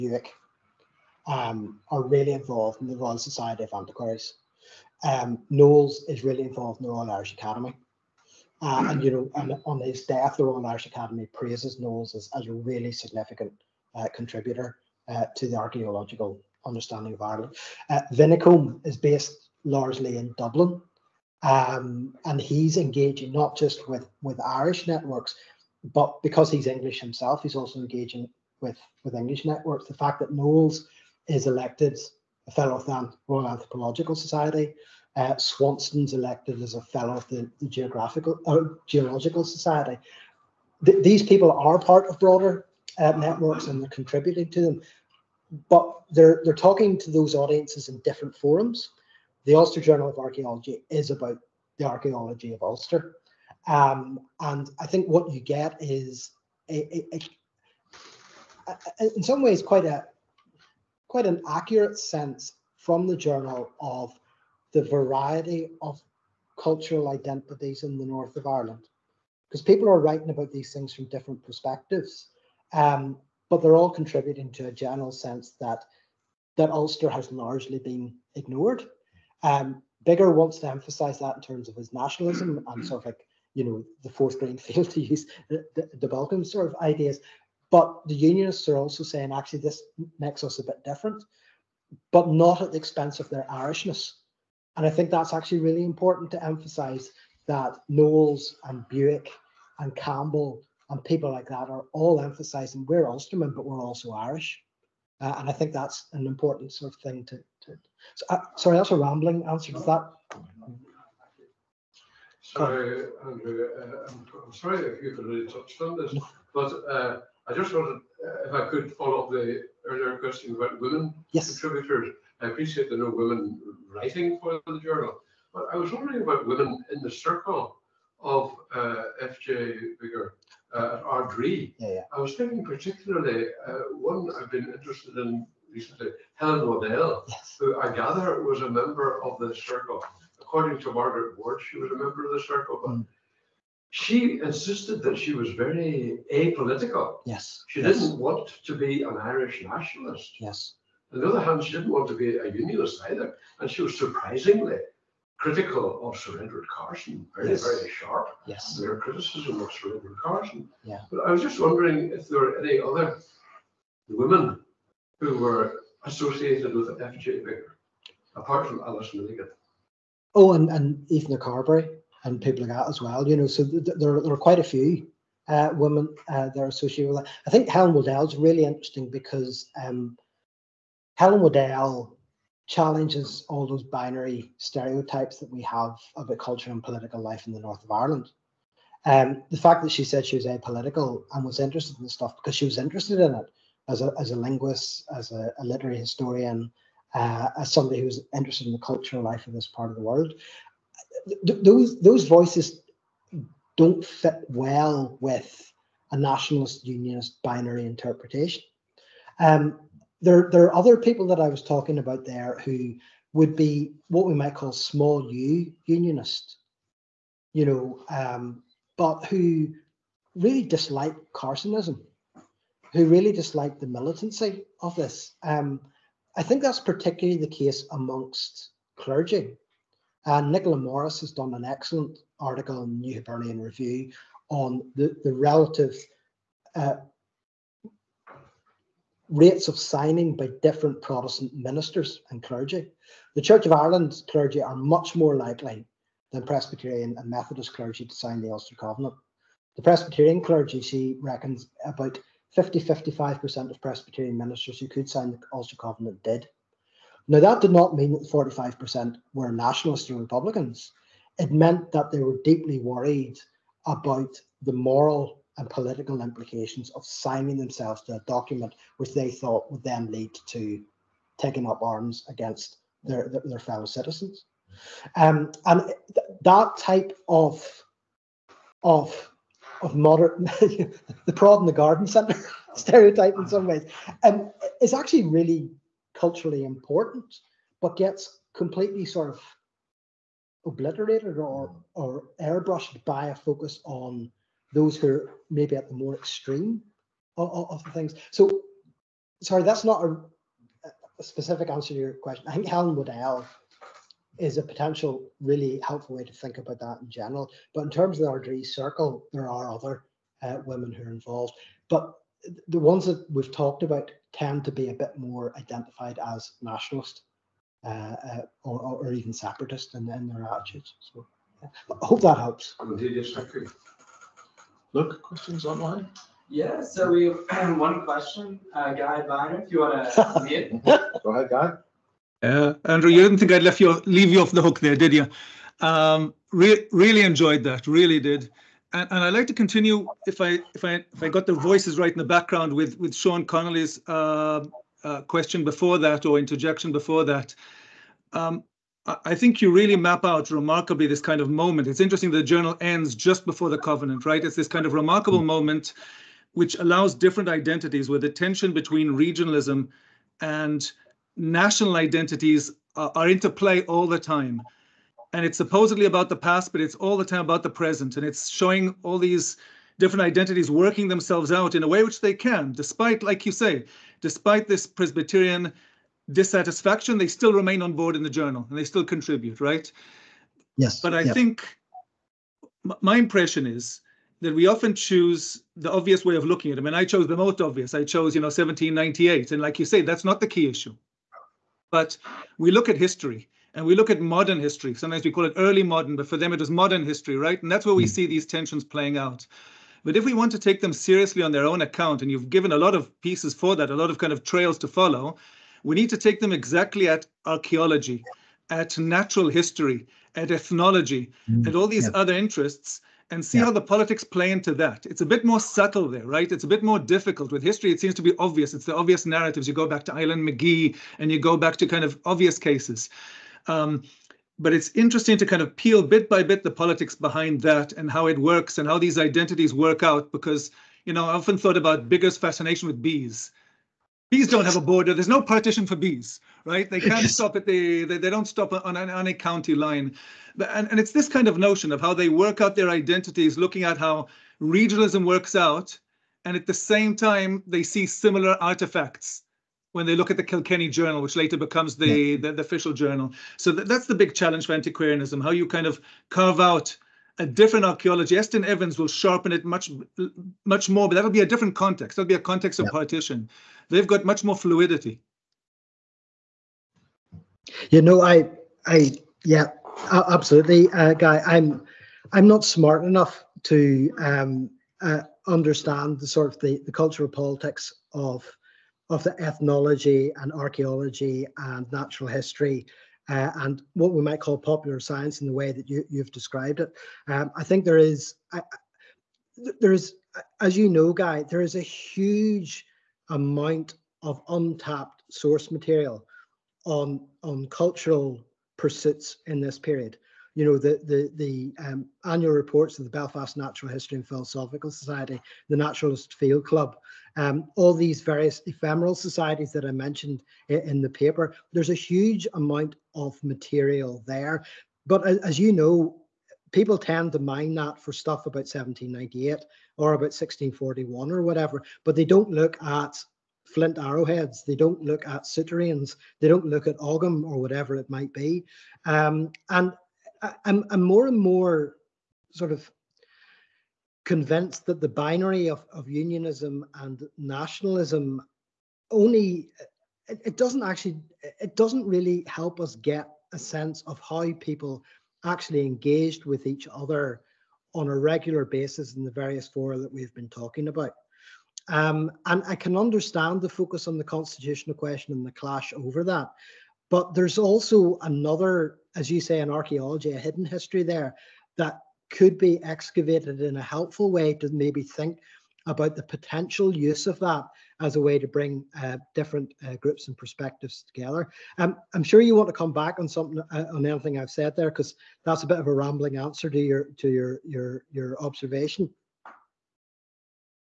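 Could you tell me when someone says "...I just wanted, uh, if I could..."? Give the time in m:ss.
1:57.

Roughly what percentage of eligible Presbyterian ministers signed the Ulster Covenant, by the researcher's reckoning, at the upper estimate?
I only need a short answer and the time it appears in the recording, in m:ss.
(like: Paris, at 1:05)
55%, at 4:12.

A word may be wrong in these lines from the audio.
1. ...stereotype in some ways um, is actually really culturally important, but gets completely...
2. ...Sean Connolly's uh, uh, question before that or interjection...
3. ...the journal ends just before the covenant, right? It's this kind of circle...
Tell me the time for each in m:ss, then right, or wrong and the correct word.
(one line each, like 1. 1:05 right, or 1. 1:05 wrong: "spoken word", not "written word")
1. 4:42 right
2. 5:43 right
3. 5:52 wrong: "remarkable", not "circle".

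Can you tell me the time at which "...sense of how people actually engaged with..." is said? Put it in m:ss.
9:03.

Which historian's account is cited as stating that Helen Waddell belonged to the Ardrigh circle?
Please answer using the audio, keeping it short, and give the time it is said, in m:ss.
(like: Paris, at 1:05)
Margaret Ward, at 2:20.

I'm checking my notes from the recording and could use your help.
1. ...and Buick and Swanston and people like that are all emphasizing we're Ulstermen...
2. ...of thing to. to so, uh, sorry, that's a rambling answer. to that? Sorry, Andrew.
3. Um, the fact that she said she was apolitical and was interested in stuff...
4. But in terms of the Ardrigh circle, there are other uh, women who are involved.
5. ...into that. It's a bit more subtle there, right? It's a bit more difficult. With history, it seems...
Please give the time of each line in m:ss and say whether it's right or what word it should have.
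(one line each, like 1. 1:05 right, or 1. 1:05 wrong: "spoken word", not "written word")
1. 1:38 wrong: "Campbell", not "Swanston"
2. 1:46 right
3. 3:09 right
4. 5:07 right
5. 6:54 right.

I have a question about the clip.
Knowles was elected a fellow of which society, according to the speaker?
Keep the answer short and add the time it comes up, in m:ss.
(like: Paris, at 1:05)
Royal Anthropological Society, at 0:33.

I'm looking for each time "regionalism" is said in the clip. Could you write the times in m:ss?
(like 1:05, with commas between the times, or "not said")
5:59, 7:24.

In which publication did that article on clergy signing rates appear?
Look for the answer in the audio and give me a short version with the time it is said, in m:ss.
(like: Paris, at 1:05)
New Hibernia Review, at 3:53.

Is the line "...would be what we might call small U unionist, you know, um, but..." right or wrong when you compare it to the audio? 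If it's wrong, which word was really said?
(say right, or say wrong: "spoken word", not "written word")
right.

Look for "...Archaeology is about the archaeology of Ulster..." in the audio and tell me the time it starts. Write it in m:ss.
0:50.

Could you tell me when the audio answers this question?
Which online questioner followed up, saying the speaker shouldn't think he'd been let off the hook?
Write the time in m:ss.
5:28.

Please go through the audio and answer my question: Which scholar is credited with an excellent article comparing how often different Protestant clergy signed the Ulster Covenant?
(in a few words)
Nicola Morris.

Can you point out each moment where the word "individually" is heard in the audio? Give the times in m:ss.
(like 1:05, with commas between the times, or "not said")
not said.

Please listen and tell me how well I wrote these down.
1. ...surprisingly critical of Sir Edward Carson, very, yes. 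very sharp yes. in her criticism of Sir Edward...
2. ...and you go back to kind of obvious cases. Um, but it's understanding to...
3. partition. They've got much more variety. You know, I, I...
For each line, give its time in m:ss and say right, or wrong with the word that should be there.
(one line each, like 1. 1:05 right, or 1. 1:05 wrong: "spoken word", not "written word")
1. 2:33 right
2. 7:01 wrong: "interesting", not "understanding"
3. 7:42 wrong: "fluidity", not "variety".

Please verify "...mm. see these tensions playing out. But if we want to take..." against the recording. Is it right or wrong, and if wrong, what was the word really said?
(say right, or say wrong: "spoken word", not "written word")
right.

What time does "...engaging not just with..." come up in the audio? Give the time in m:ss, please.
0:22.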